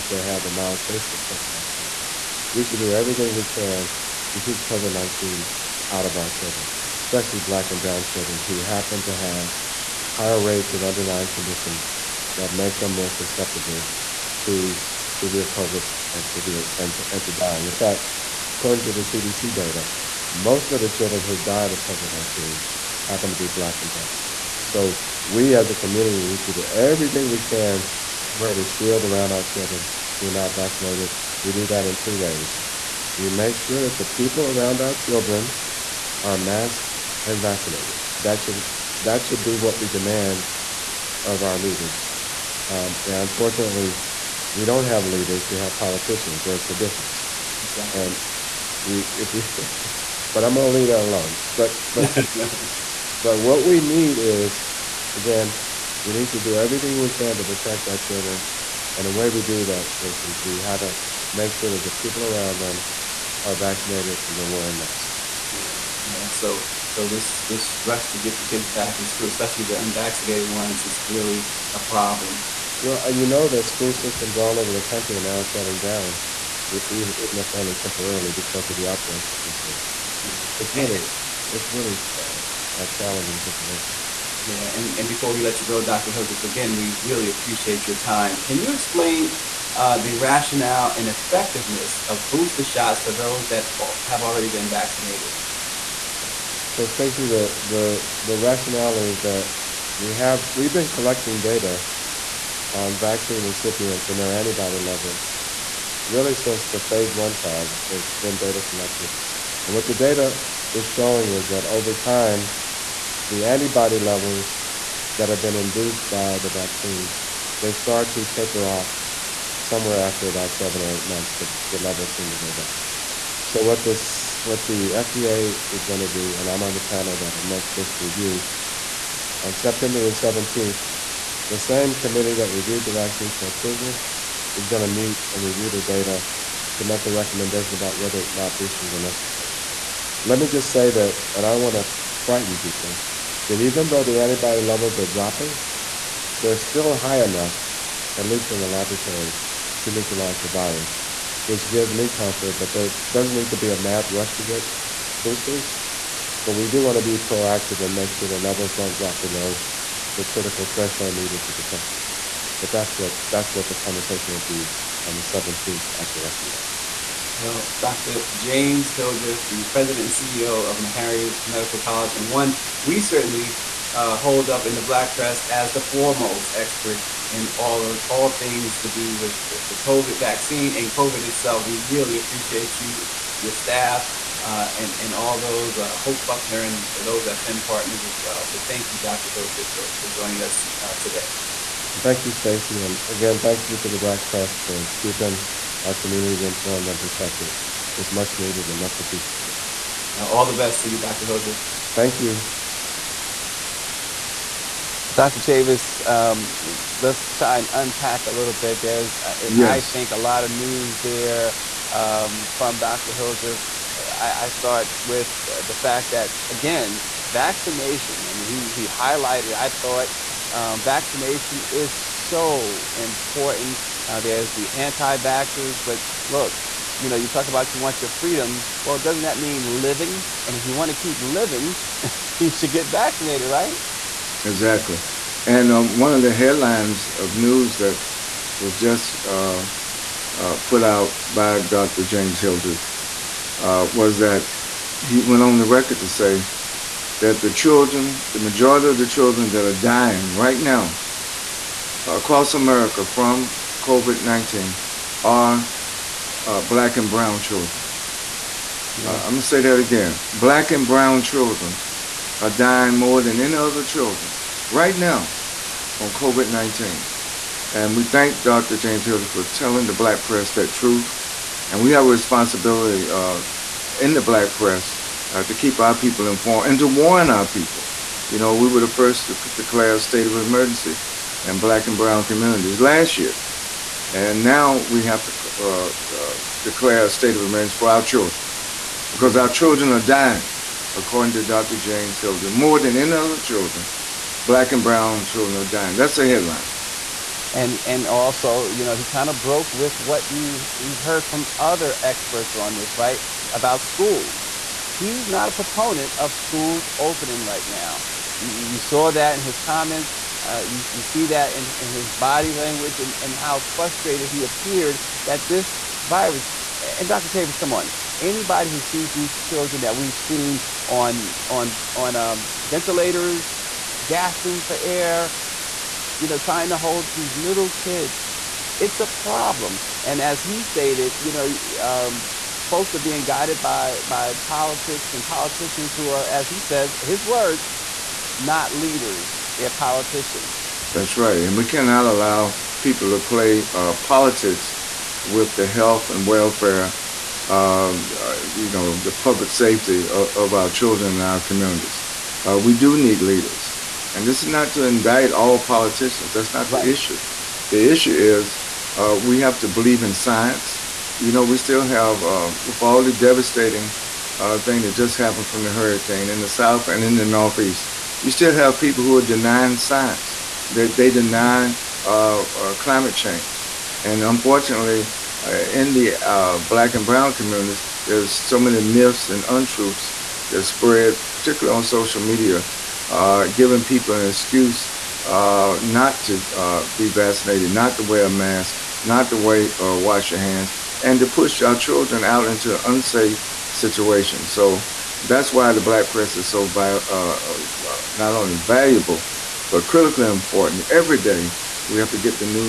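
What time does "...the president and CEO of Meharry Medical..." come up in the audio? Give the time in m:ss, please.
2:49.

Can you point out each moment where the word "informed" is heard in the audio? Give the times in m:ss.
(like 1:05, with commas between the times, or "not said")
3:16, 4:36.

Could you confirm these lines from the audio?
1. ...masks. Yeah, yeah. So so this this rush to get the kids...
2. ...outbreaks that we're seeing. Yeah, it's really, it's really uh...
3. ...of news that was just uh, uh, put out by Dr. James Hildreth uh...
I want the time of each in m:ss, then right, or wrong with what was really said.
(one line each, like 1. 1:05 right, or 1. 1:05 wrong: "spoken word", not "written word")
1. 1:04 right
2. 1:18 right
3. 3:57 right.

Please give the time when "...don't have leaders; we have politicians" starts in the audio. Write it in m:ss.
0:44.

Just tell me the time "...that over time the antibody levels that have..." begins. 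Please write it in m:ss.
1:51.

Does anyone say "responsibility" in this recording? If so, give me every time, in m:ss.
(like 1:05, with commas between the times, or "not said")
4:32.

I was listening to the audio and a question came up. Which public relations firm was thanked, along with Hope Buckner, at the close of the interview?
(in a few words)
Finn Partners.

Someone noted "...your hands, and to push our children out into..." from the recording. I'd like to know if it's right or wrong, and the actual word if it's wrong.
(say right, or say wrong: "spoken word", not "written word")
right.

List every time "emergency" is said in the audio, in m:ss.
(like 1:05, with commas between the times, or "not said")
4:40, 4:47.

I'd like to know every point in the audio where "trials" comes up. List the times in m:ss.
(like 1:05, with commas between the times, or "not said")
1:47.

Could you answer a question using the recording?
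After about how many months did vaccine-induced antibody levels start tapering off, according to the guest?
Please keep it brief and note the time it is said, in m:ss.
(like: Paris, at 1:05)
7 or 8, at 2:00.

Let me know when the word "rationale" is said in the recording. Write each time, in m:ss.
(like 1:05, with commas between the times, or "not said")
1:30, 1:38.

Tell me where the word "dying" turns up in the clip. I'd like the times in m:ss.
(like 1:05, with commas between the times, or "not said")
0:17, 4:09, 4:22, 4:50, 4:55.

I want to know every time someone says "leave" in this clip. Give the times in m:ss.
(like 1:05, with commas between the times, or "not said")
0:50.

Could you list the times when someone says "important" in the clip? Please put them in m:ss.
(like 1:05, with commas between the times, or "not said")
3:42, 6:40.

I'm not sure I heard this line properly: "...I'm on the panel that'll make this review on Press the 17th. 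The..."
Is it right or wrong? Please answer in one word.
wrong.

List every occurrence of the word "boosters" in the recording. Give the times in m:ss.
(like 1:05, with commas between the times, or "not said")
1:32, 2:18, 2:35.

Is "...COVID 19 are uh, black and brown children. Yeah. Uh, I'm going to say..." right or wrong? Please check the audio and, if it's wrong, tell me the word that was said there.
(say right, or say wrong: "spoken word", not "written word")
right.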